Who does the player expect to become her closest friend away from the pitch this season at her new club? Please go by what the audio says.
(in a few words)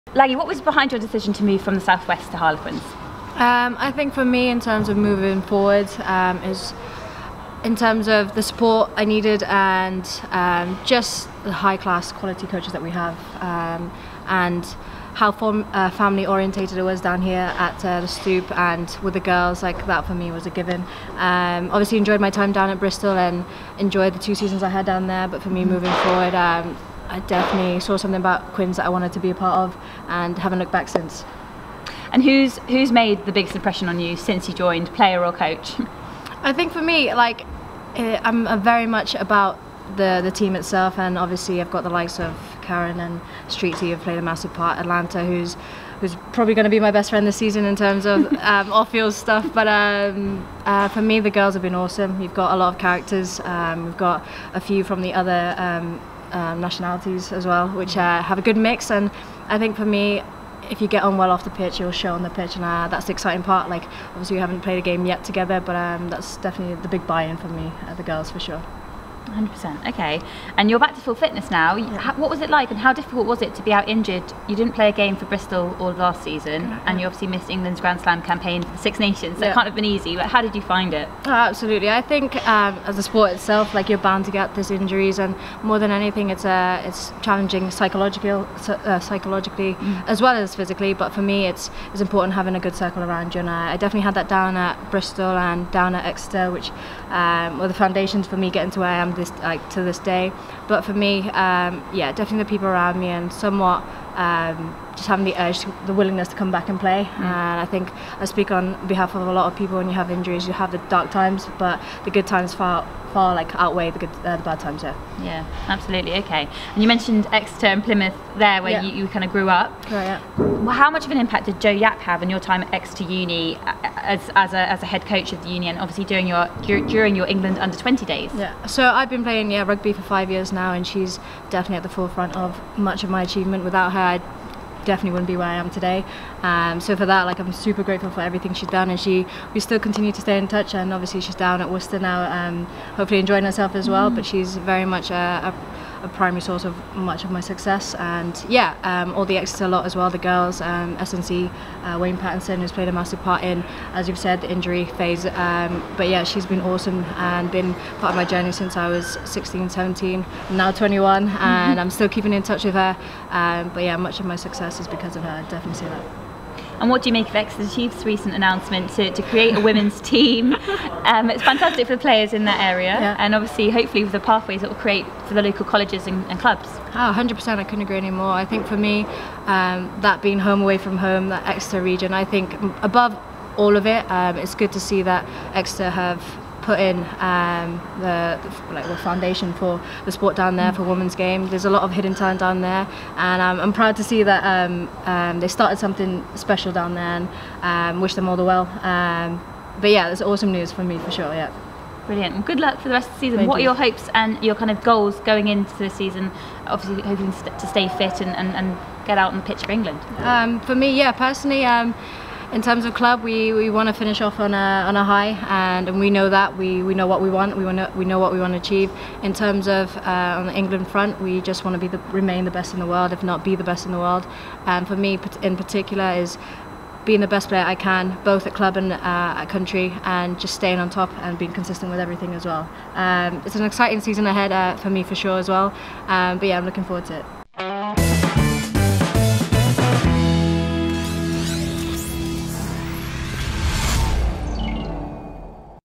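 Atlanta.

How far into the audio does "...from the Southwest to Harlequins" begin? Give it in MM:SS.
00:01.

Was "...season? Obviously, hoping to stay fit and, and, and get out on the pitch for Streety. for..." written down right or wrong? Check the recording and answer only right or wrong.
wrong.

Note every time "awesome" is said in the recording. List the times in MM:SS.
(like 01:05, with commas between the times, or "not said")
00:51, 02:36, 03:20.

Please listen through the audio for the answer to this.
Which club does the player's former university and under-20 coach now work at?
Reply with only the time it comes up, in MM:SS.
02:21.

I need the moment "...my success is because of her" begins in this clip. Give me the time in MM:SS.
02:44.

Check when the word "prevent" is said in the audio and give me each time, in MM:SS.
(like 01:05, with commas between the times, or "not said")
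not said.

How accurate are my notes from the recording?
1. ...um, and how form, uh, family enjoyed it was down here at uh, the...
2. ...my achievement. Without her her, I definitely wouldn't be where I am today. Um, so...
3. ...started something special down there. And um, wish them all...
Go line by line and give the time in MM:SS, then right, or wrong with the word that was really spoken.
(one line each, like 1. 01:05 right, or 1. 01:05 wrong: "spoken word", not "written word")
1. 00:13 wrong: "orientated", not "enjoyed"
2. 02:13 right
3. 03:15 right.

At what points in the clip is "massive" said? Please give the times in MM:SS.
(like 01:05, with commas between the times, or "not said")
00:44, 02:32.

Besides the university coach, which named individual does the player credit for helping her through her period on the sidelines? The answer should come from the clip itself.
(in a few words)
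Wayne Pattinson.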